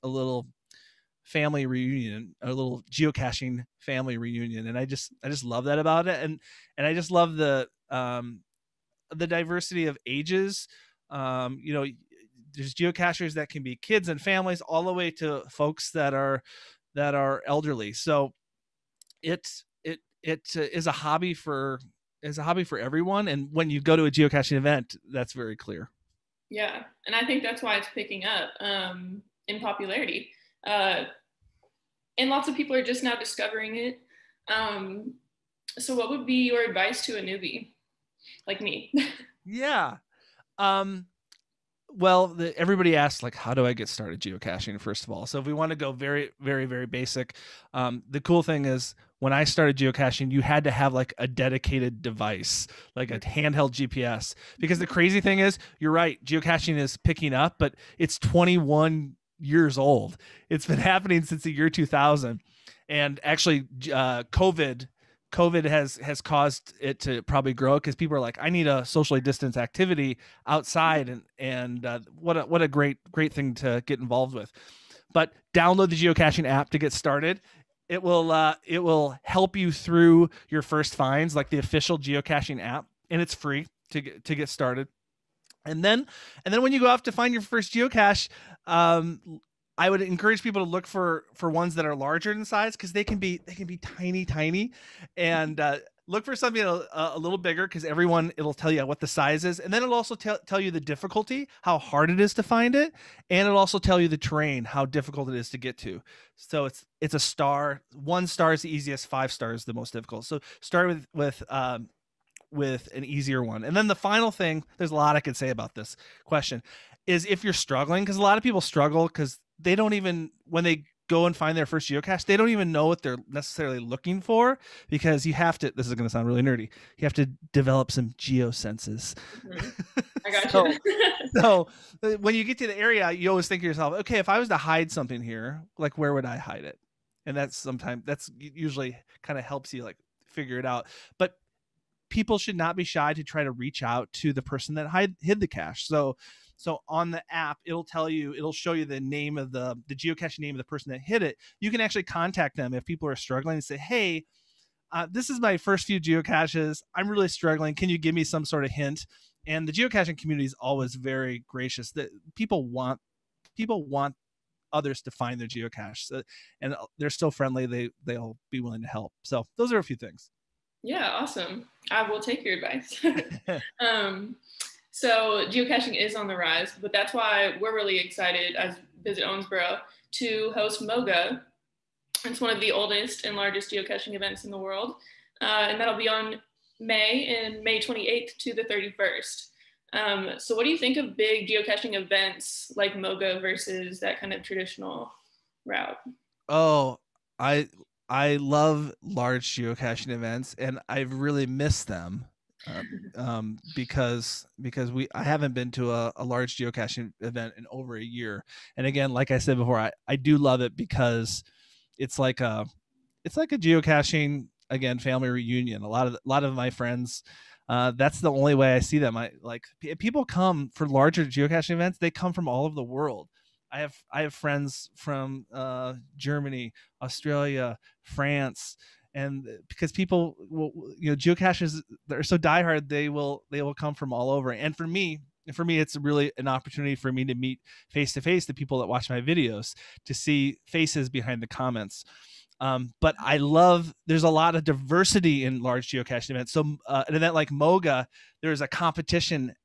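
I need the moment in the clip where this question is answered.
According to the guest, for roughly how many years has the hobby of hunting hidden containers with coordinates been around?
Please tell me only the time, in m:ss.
0:58.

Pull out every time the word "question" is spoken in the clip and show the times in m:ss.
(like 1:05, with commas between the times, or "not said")
1:56.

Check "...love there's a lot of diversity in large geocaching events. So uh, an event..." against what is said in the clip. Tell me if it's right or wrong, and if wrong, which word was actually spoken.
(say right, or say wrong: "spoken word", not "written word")
right.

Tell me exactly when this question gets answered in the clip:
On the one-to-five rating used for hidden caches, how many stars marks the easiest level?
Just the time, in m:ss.
1:47.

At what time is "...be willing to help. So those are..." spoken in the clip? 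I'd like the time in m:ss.
2:48.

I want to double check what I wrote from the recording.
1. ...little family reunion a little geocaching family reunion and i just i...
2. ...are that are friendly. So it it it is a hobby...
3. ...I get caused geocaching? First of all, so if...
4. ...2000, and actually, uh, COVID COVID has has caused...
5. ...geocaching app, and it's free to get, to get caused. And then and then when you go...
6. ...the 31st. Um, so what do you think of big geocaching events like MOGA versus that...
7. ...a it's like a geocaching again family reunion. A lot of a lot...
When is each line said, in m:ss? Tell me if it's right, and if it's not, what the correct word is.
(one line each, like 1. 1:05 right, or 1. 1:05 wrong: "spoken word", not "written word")
1. 0:00 right
2. 0:16 wrong: "elderly", not "friendly"
3. 0:43 wrong: "started", not "caused"
4. 1:01 right
5. 1:21 wrong: "started", not "caused"
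6. 3:08 right
7. 3:32 right.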